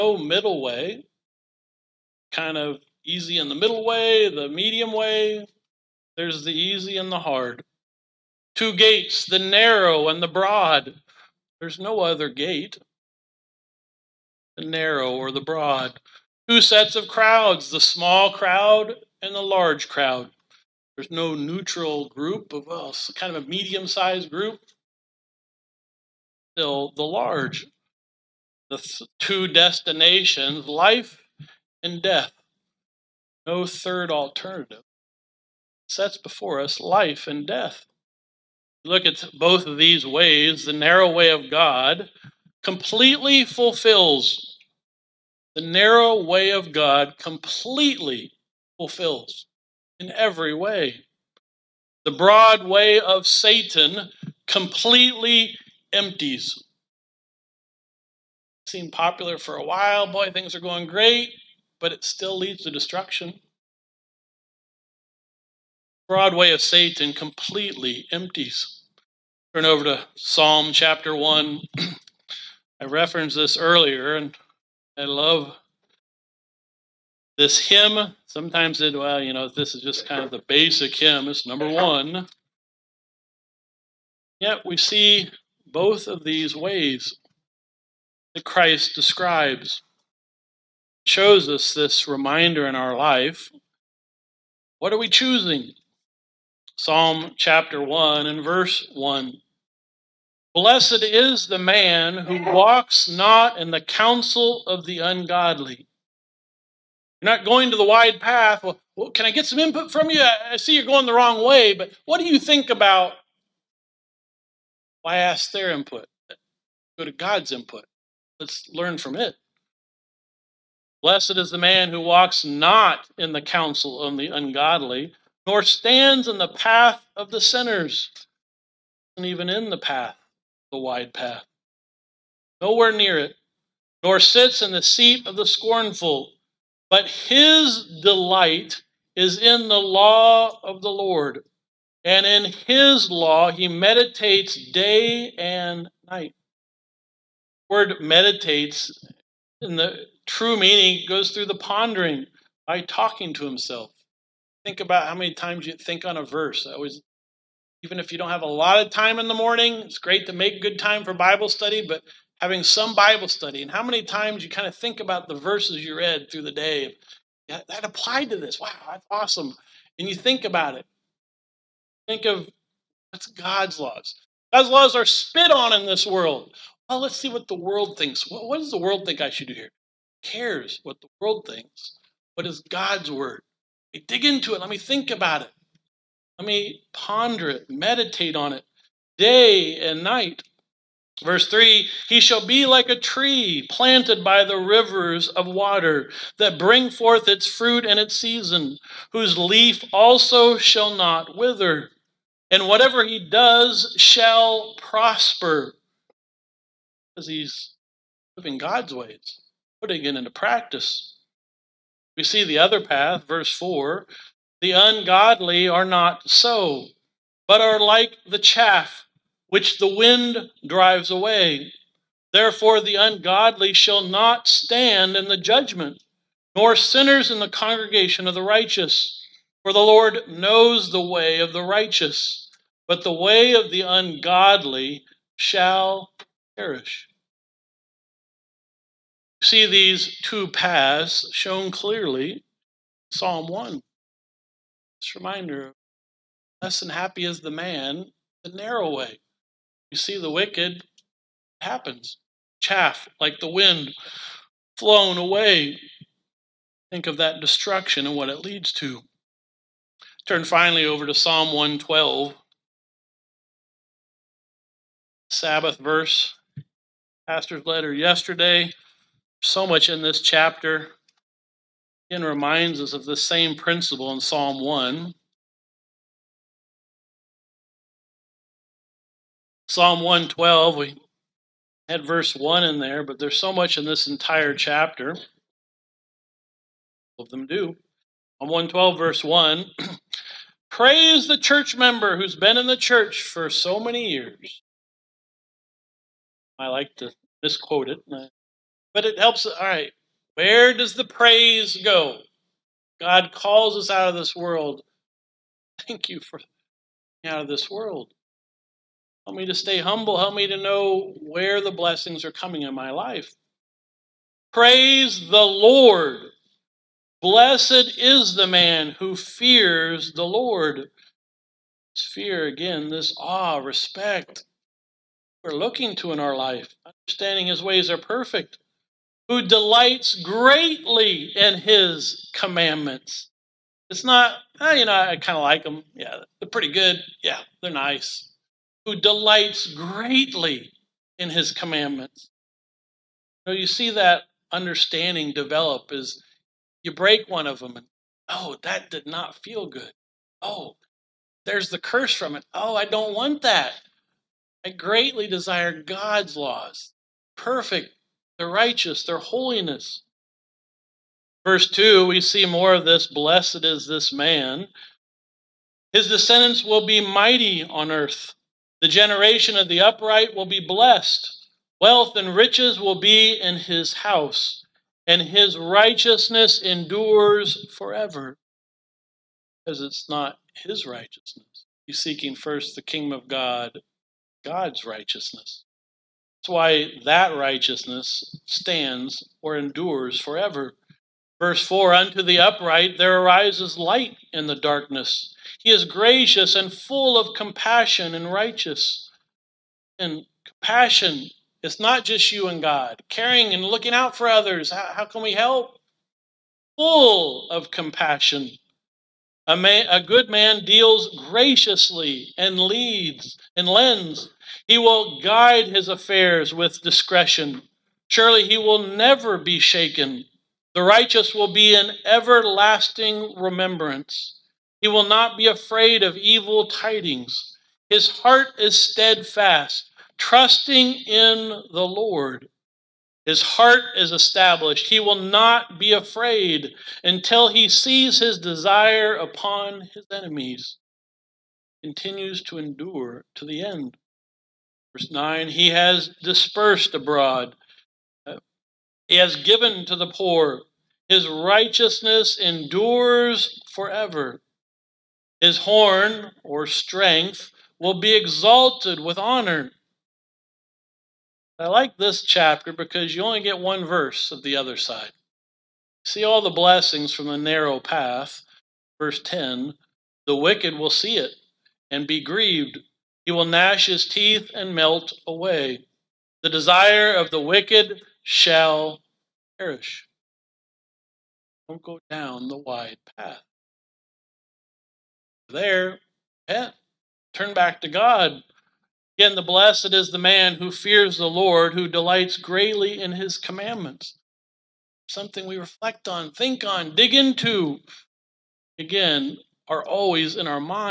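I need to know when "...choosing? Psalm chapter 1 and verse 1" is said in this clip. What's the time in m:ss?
1:35.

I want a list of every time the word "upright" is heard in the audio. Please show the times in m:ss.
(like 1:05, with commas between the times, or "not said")
6:09, 6:32.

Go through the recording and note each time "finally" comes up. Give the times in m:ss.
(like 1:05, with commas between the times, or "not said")
4:20.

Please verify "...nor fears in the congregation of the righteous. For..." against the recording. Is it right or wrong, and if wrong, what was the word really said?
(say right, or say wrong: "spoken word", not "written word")
wrong: "sinners", not "fears".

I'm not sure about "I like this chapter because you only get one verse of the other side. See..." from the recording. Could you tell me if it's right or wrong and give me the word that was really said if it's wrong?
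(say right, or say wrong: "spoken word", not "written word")
right.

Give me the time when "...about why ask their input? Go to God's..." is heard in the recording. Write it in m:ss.
1:52.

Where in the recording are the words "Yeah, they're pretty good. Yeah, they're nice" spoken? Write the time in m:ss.
5:35.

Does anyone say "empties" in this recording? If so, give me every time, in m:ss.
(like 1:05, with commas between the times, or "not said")
0:55, 1:08.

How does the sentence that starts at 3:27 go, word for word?
Because he's living God's ways, putting it into practice.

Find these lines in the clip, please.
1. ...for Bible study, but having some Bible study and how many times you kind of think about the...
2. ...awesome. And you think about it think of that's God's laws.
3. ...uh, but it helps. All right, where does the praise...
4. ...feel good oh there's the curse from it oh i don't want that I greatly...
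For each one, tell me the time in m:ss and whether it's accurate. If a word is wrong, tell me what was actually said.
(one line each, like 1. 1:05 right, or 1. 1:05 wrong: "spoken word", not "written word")
1. 2:41 right
2. 2:49 right
3. 4:58 right
4. 5:49 right.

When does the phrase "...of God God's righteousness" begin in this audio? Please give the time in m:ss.
6:23.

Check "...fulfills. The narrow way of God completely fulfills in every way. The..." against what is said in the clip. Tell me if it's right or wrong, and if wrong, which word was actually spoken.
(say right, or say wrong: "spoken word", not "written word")
right.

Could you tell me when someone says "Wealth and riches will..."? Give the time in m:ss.
6:11.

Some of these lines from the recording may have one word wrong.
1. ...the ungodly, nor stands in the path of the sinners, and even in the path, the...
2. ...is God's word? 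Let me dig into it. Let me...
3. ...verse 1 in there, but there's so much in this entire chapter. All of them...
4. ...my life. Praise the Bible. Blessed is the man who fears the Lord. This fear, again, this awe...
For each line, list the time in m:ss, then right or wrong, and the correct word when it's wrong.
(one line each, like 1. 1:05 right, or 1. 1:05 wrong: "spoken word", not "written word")
1. 2:04 right
2. 3:02 right
3. 4:42 right
4. 5:12 wrong: "Lord", not "Bible".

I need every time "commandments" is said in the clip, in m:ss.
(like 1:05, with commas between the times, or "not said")
5:32, 5:41, 8:13.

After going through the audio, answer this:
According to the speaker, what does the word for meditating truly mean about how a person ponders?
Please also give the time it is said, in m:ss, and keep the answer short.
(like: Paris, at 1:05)
talking to himself, at 2:32.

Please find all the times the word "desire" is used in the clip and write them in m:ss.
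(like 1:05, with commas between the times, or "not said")
5:55, 7:18, 7:56.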